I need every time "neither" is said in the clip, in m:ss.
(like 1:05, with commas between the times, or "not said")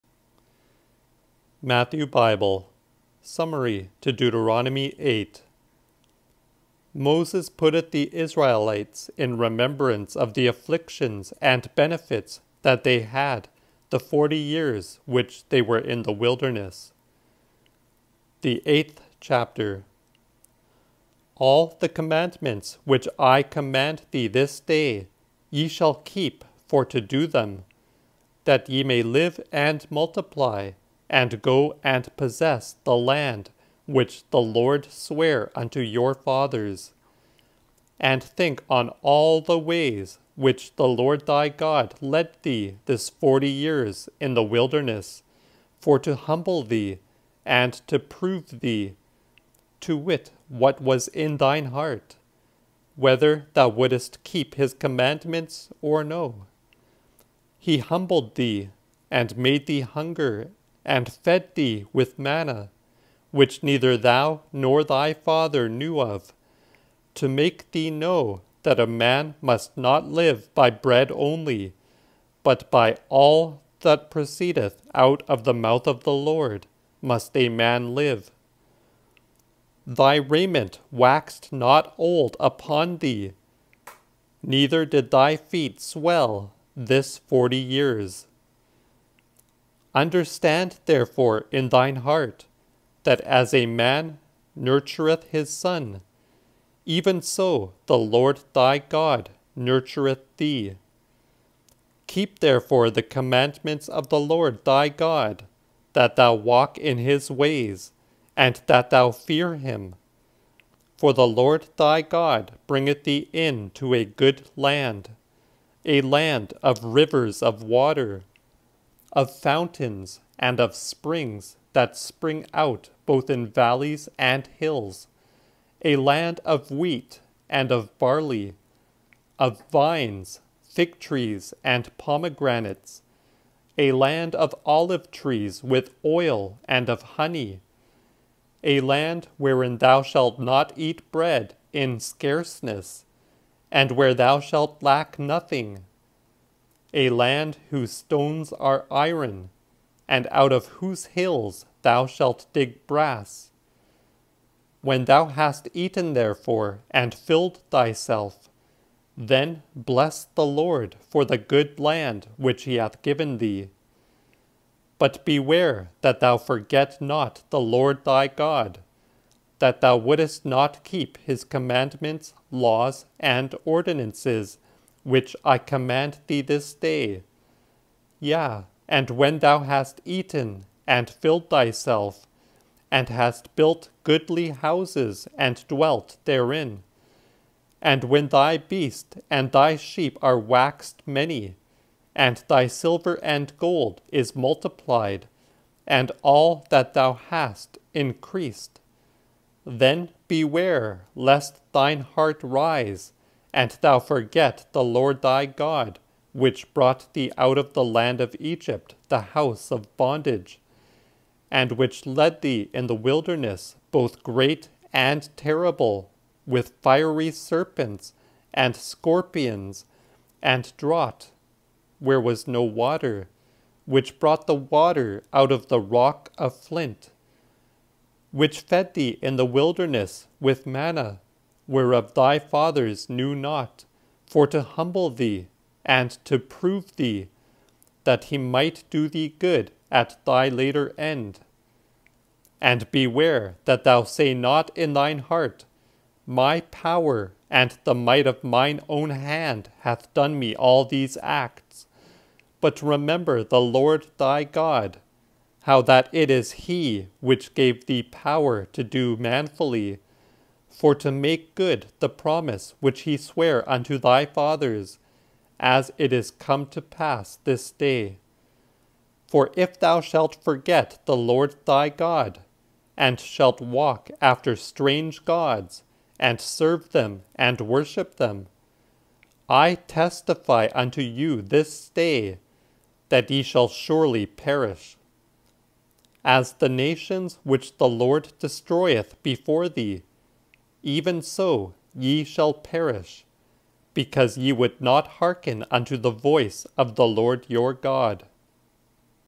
1:03, 1:24.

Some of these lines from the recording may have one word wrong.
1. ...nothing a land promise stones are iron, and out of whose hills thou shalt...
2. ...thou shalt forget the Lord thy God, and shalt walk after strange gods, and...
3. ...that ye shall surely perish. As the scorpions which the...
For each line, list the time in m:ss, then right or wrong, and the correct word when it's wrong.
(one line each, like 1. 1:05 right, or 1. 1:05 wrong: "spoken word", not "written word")
1. 2:25 wrong: "whose", not "promise"
2. 4:29 right
3. 4:43 wrong: "nations", not "scorpions".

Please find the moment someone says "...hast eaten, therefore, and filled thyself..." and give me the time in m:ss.
2:35.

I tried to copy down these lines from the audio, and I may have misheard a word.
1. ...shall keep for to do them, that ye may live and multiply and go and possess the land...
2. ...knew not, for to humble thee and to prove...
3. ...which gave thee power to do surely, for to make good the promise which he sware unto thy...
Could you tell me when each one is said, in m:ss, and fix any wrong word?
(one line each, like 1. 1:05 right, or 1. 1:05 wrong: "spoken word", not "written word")
1. 0:25 right
2. 3:53 right
3. 4:17 wrong: "manfully", not "surely".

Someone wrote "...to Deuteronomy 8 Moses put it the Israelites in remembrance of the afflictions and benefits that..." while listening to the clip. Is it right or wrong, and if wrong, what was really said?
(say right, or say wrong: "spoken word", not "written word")
right.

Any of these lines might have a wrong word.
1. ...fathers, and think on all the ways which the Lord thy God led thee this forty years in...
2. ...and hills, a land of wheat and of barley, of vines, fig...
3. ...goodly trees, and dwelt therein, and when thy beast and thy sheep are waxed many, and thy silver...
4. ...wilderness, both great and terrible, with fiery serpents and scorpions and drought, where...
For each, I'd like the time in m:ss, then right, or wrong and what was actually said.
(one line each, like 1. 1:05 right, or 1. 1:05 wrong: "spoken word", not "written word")
1. 0:36 right
2. 2:04 right
3. 3:04 wrong: "houses", not "trees"
4. 3:32 right.